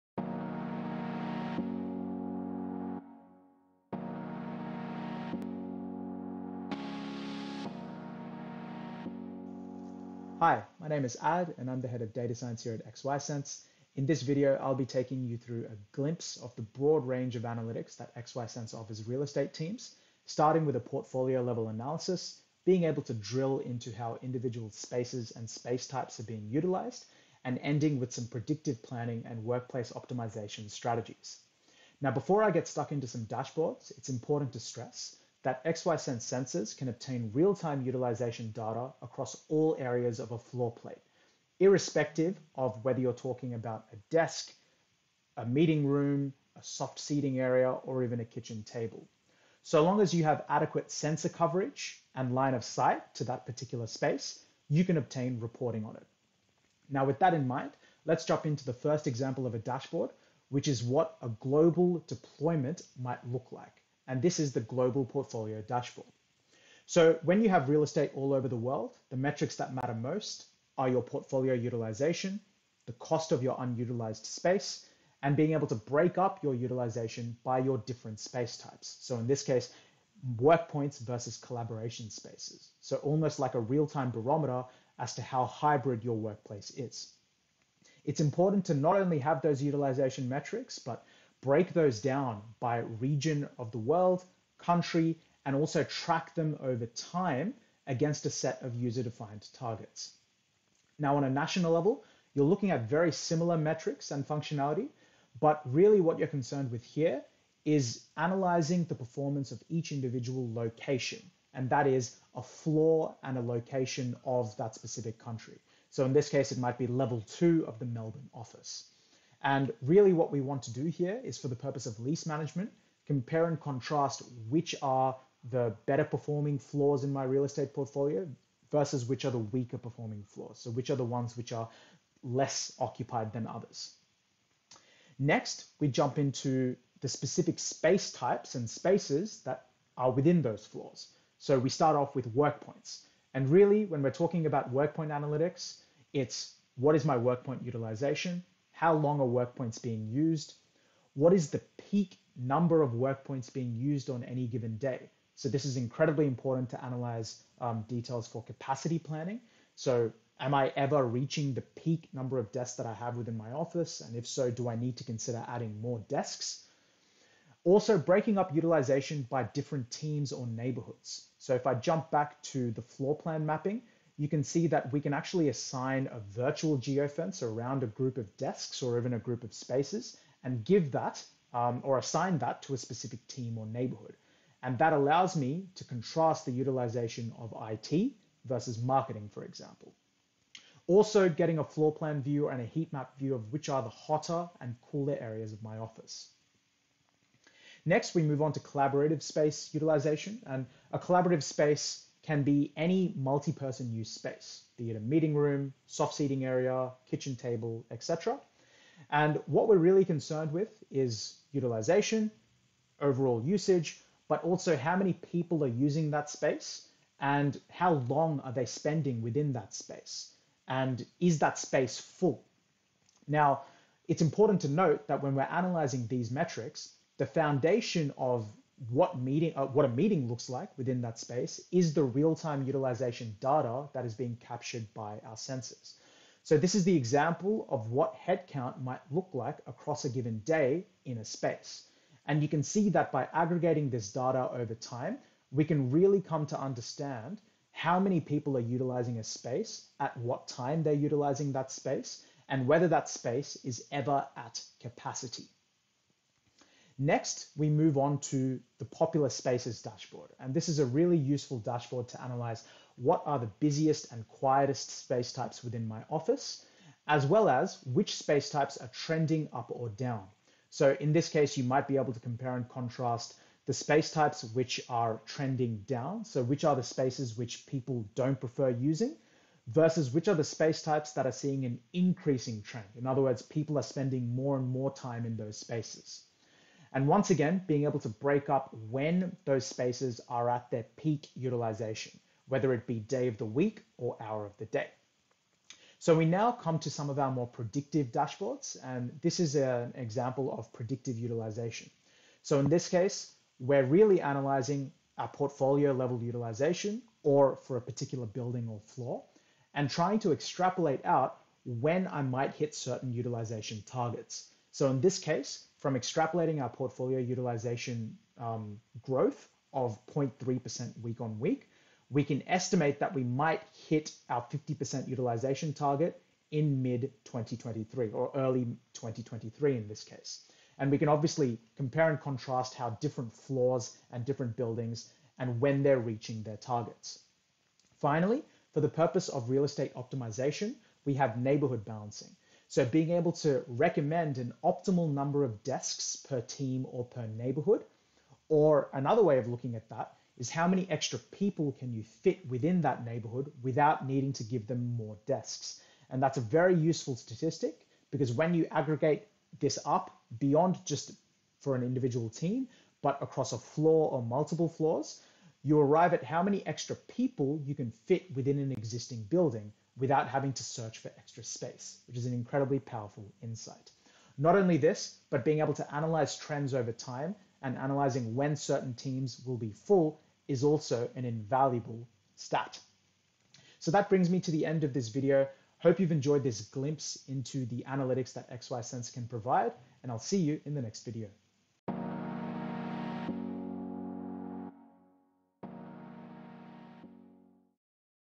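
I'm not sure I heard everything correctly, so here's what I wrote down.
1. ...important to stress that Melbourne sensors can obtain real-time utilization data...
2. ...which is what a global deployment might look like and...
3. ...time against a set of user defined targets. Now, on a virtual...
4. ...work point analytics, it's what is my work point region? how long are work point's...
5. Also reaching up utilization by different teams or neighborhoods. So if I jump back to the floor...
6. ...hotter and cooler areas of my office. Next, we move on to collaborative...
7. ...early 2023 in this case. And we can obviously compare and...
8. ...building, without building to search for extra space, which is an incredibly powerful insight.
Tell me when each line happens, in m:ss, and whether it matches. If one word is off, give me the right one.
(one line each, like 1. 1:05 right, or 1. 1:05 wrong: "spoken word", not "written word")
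1. 0:34 wrong: "XYSense", not "Melbourne"
2. 1:00 right
3. 1:36 wrong: "national", not "virtual"
4. 2:24 wrong: "utilization", not "region"
5. 2:47 wrong: "breaking", not "reaching"
6. 3:13 right
7. 5:28 right
8. 6:09 wrong: "having", not "building".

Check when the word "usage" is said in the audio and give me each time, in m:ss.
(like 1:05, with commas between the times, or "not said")
3:33.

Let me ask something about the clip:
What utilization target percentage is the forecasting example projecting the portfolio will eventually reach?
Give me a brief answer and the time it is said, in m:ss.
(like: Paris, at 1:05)
50%, at 5:24.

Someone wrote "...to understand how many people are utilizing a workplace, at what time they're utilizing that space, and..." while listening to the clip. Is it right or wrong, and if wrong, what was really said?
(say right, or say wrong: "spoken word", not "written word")
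wrong: "space", not "workplace".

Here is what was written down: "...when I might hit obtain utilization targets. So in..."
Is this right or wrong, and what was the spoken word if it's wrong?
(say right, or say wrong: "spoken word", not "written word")
wrong: "certain", not "obtain".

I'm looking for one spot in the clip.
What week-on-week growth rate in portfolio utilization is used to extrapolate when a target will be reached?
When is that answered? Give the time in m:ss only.
5:20.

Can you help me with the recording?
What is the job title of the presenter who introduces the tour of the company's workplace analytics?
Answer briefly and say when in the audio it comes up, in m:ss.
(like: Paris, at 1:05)
Head of data science, at 0:11.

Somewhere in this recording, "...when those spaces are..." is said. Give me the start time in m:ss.
4:48.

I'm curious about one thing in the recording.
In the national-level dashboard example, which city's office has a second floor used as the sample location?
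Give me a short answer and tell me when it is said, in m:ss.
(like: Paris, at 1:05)
Melbourne, at 1:57.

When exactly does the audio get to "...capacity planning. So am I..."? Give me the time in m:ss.
2:38.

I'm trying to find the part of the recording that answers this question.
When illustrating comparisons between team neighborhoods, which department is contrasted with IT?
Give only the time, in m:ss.
3:08.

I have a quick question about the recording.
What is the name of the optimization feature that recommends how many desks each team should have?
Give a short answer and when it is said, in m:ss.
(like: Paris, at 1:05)
Neighborhood balancing, at 5:41.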